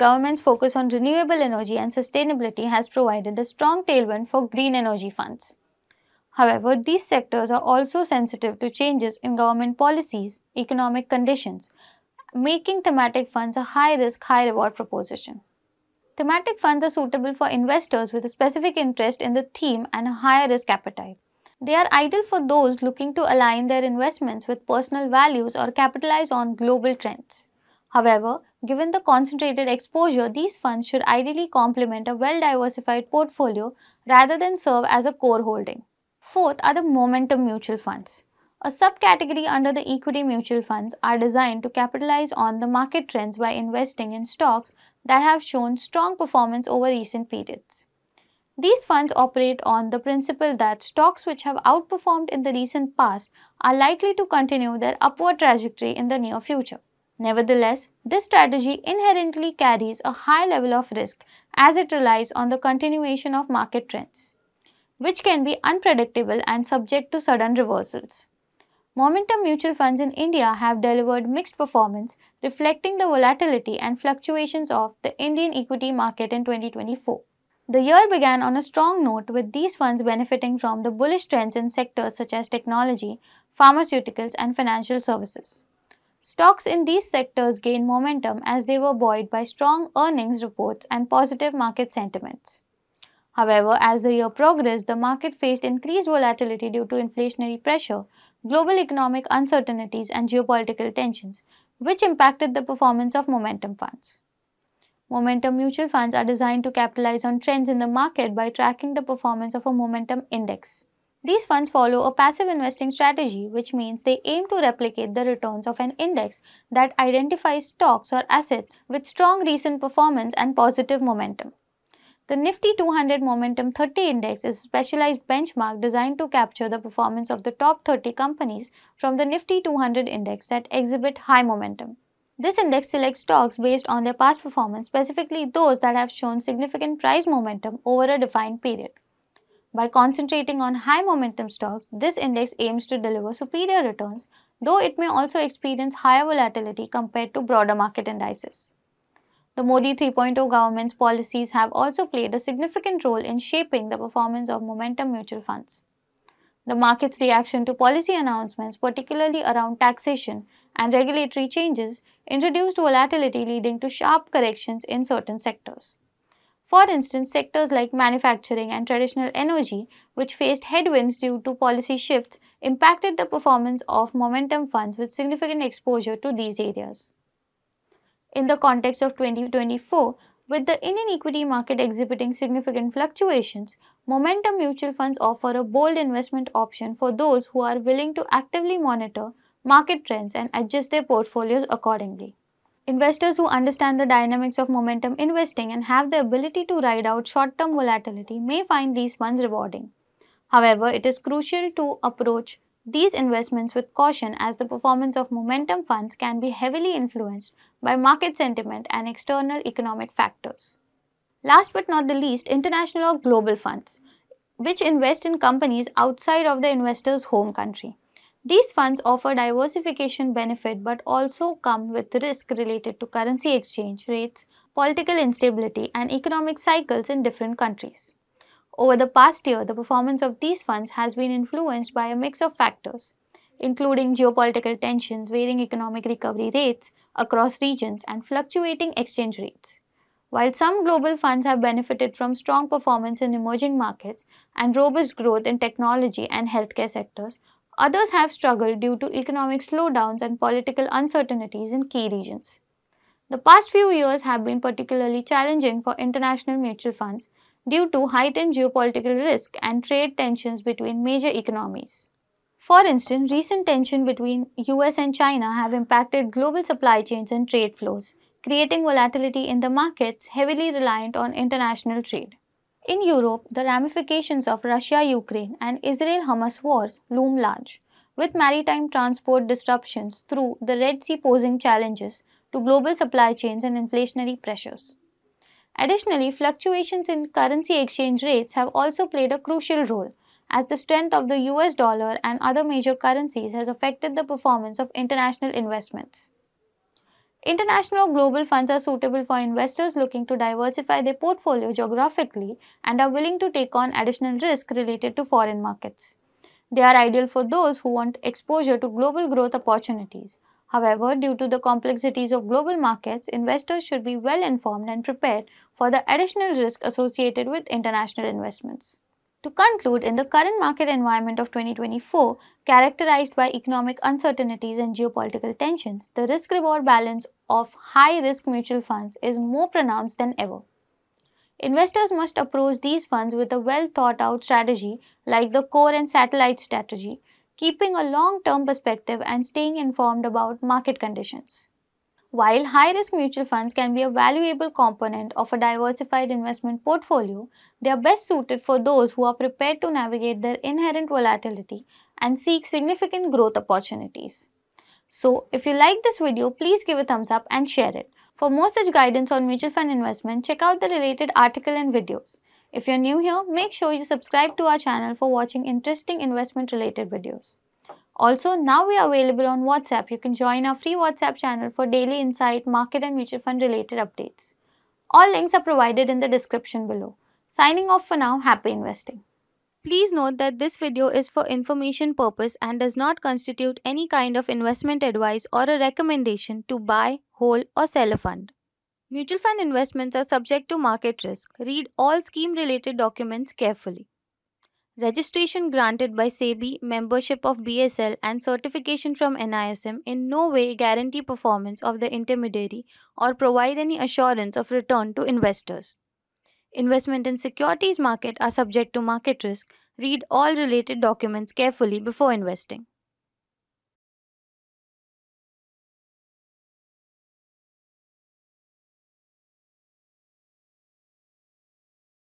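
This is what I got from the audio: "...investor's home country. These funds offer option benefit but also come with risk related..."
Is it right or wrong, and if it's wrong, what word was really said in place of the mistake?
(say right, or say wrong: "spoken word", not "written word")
wrong: "diversification", not "option".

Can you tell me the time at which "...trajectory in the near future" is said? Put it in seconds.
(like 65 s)
55 s.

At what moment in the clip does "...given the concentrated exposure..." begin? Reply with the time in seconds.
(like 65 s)
28 s.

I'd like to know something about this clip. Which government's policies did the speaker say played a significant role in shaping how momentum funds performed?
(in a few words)
Modi 3.0.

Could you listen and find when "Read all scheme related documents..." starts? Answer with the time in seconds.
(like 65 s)
391 s.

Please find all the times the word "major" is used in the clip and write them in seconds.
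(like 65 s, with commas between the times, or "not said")
261 s, 292 s.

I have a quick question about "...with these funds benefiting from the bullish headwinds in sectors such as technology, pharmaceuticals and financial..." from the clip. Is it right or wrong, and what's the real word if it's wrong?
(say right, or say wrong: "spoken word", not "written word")
wrong: "trends", not "headwinds".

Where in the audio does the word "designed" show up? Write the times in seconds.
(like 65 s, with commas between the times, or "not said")
41 s, 106 s, 125 s.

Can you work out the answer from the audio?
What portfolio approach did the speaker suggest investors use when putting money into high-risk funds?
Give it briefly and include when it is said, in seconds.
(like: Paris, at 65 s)
Core and satellite strategy, at 335 s.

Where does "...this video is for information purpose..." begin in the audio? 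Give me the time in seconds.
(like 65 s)
380 s.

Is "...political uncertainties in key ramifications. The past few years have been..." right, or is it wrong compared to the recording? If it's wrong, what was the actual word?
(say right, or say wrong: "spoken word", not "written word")
wrong: "regions", not "ramifications".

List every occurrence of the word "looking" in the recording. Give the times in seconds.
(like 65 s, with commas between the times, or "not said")
22 s, 299 s.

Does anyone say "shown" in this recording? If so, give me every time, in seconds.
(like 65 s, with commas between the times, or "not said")
45 s, 136 s.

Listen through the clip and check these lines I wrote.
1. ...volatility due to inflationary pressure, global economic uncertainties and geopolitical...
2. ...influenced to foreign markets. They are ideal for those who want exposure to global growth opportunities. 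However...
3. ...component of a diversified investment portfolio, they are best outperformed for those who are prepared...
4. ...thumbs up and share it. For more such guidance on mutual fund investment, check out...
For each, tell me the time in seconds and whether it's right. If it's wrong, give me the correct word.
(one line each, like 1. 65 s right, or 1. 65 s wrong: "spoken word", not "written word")
1. 96 s right
2. 304 s wrong: "related", not "influenced"
3. 344 s wrong: "suited", not "outperformed"
4. 357 s right.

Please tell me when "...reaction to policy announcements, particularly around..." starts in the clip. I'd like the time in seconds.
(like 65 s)
157 s.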